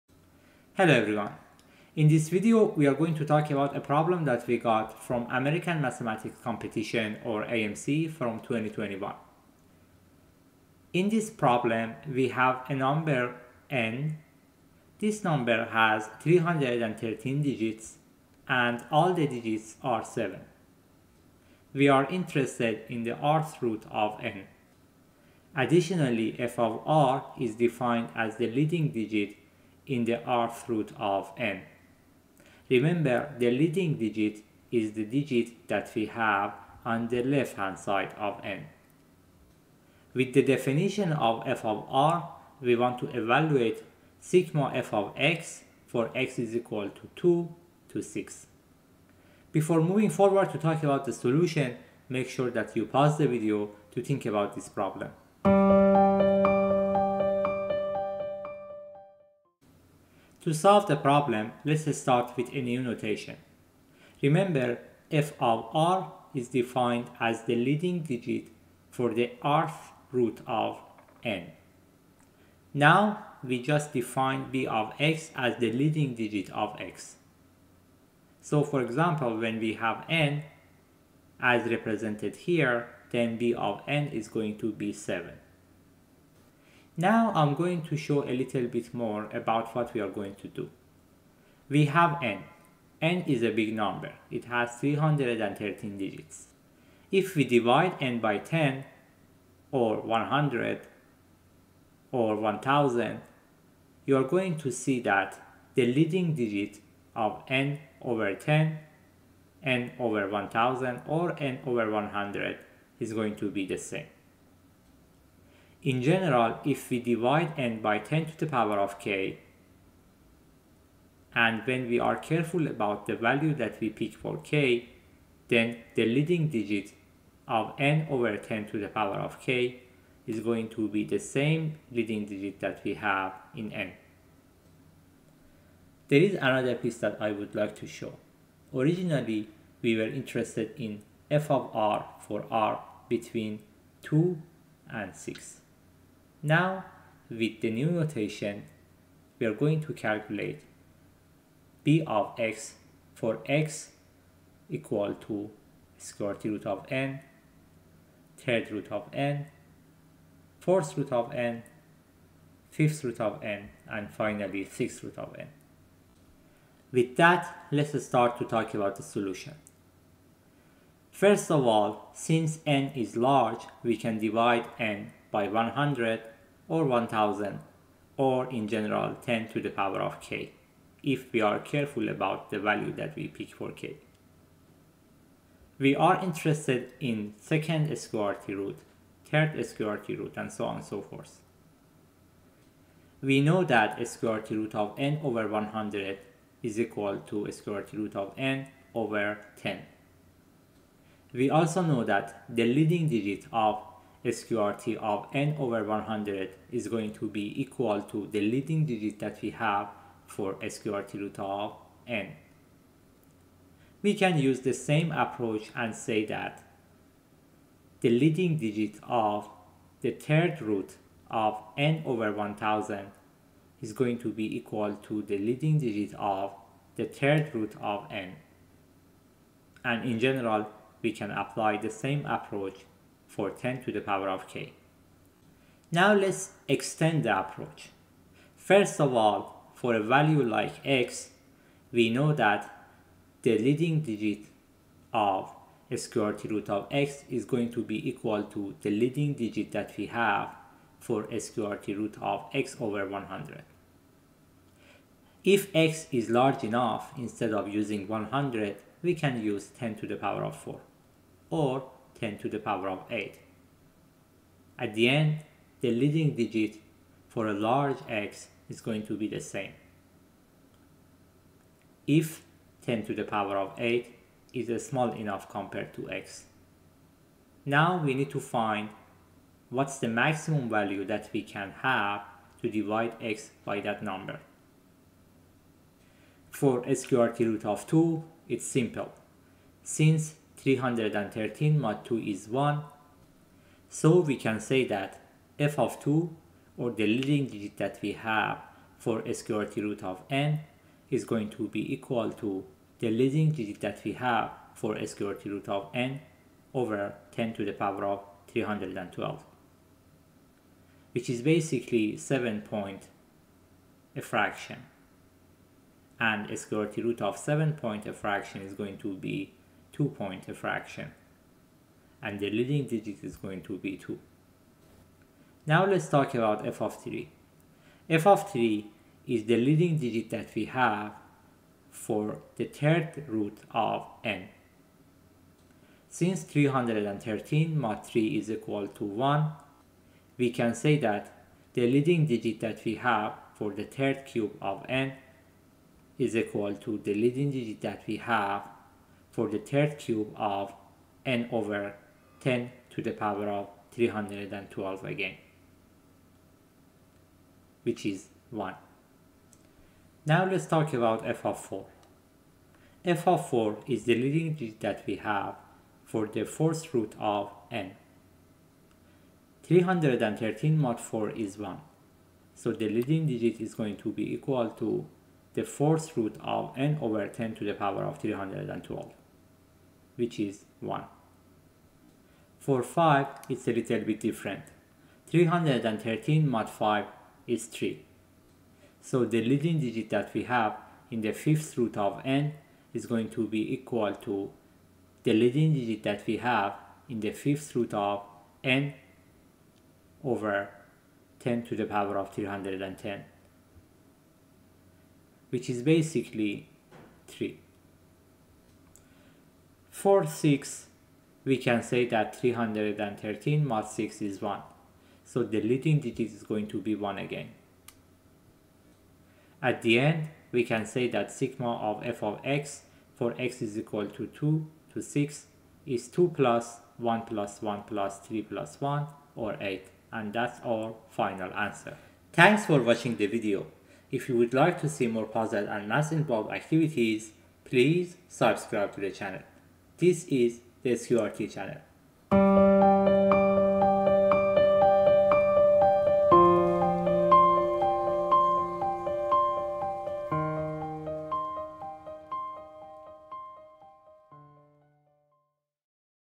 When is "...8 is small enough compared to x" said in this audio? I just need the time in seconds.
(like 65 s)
273 s.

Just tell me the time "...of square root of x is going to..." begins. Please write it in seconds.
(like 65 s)
245 s.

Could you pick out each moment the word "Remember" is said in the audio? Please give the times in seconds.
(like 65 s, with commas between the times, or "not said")
32 s, 64 s.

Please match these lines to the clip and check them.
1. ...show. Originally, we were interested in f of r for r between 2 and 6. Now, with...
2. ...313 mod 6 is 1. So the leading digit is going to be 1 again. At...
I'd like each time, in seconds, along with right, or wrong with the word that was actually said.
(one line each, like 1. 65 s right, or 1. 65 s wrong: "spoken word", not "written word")
1. 137 s right
2. 412 s right.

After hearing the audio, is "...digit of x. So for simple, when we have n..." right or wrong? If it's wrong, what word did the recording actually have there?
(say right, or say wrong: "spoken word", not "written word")
wrong: "example", not "simple".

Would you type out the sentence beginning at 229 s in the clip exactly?
And in general, we can apply the same approach for 10 to the power of k.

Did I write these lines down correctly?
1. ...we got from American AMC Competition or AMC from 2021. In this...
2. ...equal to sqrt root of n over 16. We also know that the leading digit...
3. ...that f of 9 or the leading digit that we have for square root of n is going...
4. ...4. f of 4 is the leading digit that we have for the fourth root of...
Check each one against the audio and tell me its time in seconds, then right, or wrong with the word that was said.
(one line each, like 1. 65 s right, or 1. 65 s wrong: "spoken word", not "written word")
1. 4 s wrong: "Mathematics", not "AMC"
2. 196 s wrong: "10", not "16"
3. 294 s wrong: "2", not "9"
4. 361 s right.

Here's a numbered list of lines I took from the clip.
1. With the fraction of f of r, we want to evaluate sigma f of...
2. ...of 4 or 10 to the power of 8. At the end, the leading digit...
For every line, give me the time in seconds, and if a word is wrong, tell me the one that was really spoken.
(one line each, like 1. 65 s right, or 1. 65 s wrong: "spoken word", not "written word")
1. 40 s wrong: "definition", not "fraction"
2. 260 s right.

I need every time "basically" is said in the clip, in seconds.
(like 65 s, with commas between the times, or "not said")
311 s, 405 s.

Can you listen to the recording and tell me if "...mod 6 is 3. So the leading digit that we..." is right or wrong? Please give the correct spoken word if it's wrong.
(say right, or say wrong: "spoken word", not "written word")
wrong: "5", not "6".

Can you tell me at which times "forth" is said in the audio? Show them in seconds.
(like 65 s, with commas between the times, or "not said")
191 s.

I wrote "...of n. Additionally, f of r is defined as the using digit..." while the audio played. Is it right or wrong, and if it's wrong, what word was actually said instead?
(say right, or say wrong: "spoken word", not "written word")
wrong: "leading", not "using".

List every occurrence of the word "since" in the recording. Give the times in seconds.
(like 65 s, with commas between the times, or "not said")
172 s, 289 s, 336 s.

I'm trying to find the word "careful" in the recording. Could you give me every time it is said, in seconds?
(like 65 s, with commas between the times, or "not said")
122 s, 181 s.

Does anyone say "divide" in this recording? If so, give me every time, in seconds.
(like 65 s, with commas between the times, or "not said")
97 s, 116 s, 174 s, 282 s.